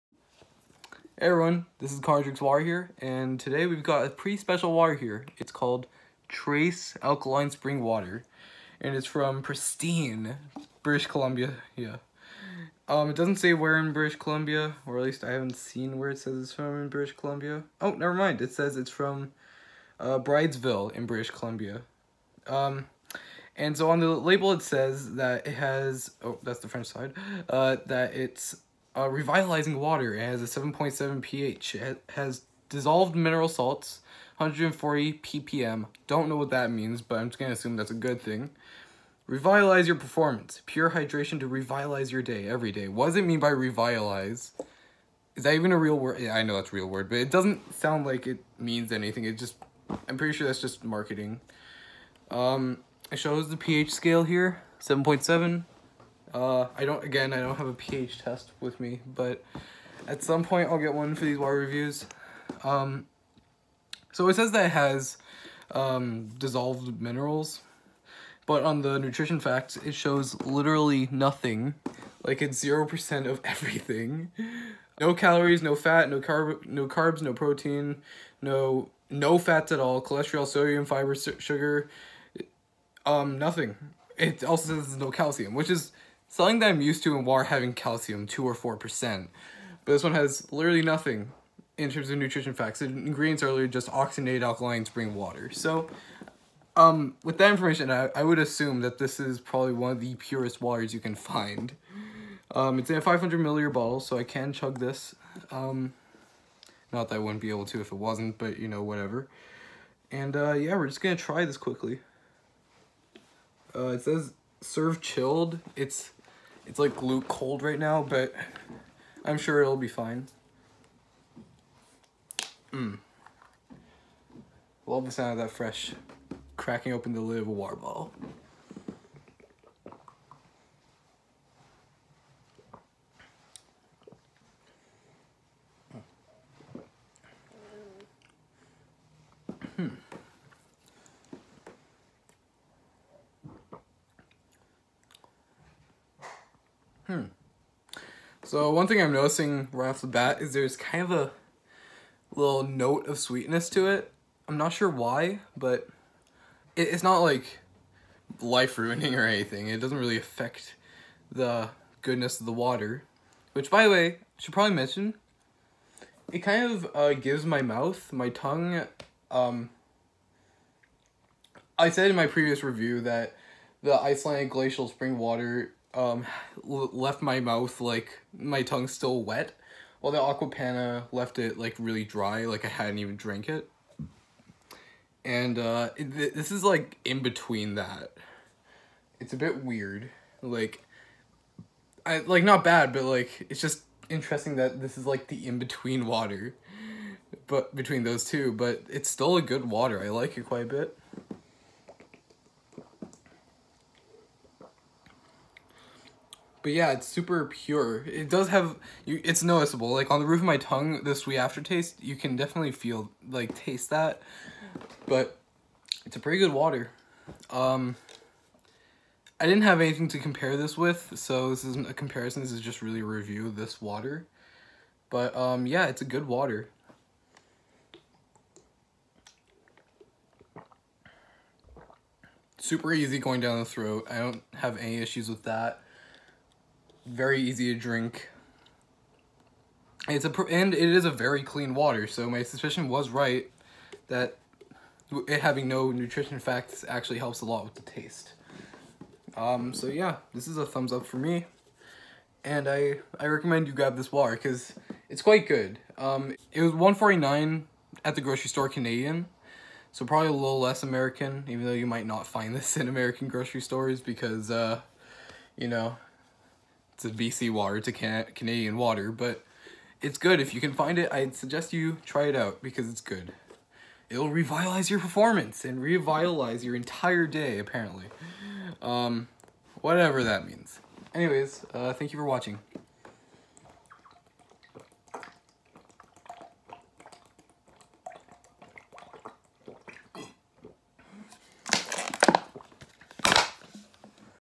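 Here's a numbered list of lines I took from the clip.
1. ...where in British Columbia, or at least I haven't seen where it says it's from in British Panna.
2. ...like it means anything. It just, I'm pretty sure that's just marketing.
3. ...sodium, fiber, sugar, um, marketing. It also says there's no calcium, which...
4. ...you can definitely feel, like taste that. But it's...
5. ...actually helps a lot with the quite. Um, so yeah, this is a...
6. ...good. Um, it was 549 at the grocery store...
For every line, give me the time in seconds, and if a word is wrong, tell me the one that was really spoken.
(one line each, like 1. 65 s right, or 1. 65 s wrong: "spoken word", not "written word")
1. 13 s wrong: "Columbia", not "Panna"
2. 48 s right
3. 80 s wrong: "nothing", not "marketing"
4. 212 s right
5. 246 s wrong: "taste", not "quite"
6. 255 s wrong: "149", not "549".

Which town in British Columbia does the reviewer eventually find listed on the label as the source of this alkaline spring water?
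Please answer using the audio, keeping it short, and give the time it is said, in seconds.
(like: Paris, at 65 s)
Bridesville, at 20 s.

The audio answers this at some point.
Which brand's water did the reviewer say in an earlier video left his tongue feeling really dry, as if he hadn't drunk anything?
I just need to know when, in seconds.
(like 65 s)
180 s.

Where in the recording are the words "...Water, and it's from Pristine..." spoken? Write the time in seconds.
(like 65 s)
7 s.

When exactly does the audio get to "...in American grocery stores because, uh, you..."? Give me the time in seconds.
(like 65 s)
262 s.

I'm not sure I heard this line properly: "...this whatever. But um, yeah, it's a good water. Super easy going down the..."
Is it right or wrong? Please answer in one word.
wrong.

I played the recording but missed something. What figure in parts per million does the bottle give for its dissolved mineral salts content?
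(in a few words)
140 ppm.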